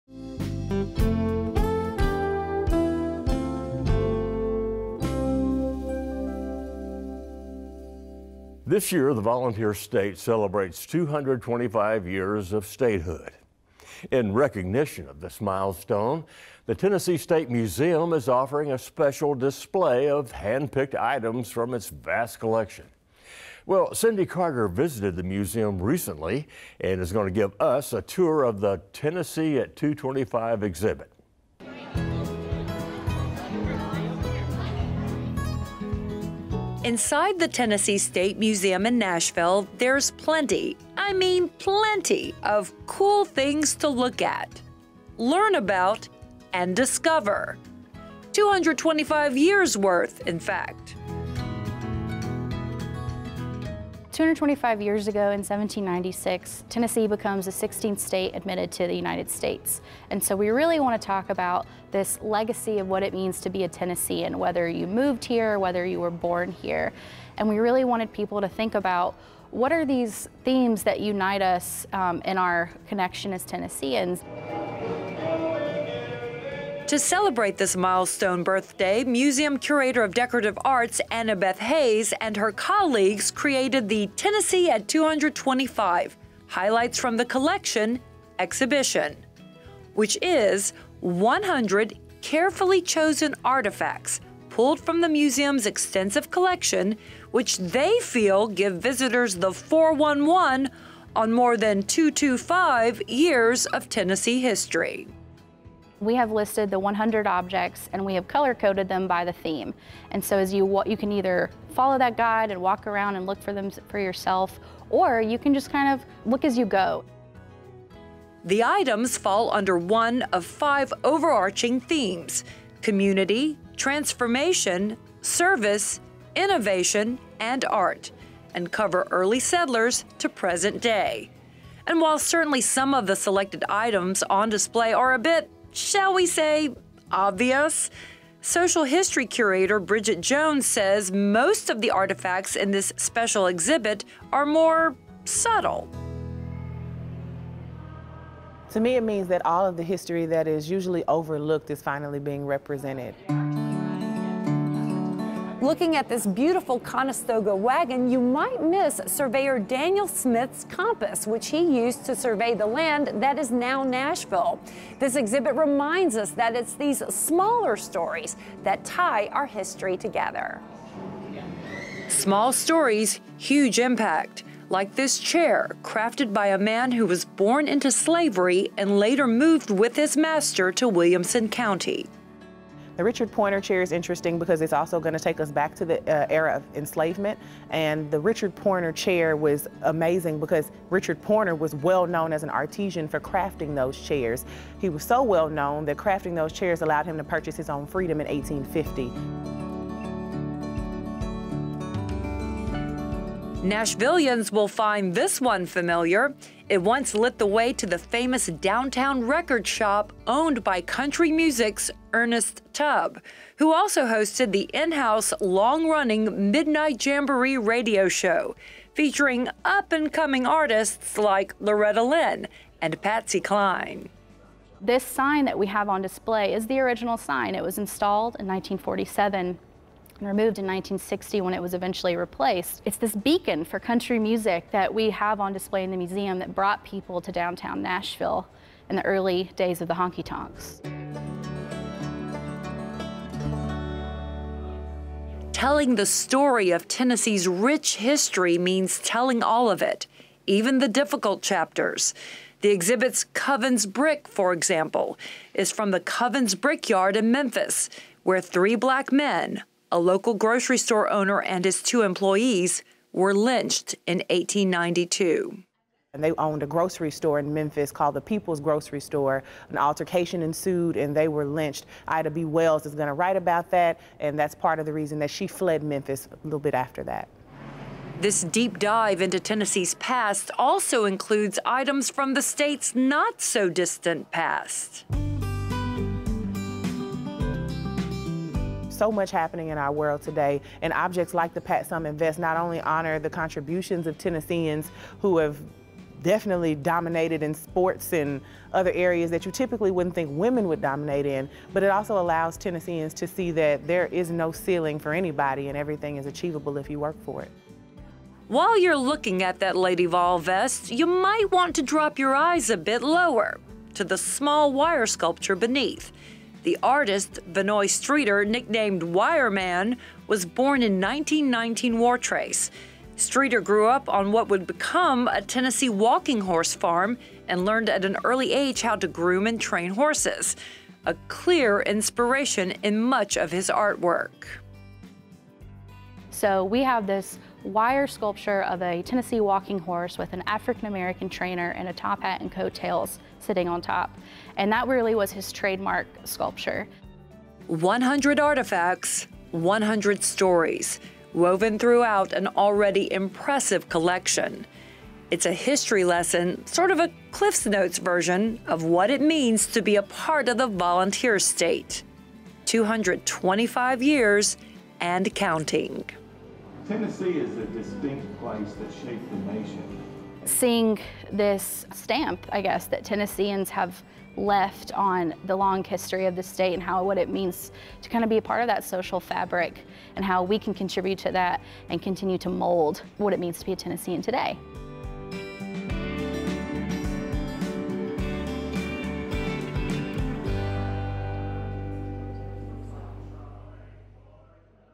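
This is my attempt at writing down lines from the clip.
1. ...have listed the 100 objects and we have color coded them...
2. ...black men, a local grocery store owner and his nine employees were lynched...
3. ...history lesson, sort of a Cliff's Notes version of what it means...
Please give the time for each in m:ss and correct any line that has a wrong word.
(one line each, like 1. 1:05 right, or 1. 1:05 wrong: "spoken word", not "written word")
1. 1:46 right
2. 4:18 wrong: "two", not "nine"
3. 5:55 right.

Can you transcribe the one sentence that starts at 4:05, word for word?
Telling the story of Tennessee's rich history means telling all of it, even the difficult chapters.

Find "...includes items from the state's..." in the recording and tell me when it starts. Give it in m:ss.
4:41.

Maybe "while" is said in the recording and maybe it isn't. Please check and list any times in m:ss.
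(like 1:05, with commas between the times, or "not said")
2:12, 5:08.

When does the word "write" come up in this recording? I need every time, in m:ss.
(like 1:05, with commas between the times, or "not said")
4:33.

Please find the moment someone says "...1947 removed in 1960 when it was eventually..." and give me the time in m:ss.
3:48.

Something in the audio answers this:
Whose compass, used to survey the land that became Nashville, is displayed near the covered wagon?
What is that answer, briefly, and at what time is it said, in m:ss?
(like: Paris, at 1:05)
Daniel Smith, at 2:39.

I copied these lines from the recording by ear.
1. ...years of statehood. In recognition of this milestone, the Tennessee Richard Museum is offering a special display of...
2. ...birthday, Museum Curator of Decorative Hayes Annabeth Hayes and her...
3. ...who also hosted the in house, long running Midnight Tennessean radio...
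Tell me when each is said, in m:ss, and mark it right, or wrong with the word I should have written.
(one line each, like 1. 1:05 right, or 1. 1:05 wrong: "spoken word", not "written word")
1. 0:12 wrong: "State", not "Richard"
2. 1:18 wrong: "Arts", not "Hayes"
3. 3:33 wrong: "Jamboree", not "Tennessean".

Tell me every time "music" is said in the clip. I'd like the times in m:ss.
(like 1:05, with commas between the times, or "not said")
3:31, 3:54.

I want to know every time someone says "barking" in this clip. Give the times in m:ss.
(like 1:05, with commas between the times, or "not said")
not said.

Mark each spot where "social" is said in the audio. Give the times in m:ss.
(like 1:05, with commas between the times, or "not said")
2:18, 6:18.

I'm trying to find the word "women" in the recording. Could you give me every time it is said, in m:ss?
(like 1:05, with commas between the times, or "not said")
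5:00.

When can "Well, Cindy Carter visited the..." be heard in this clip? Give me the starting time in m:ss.
0:23.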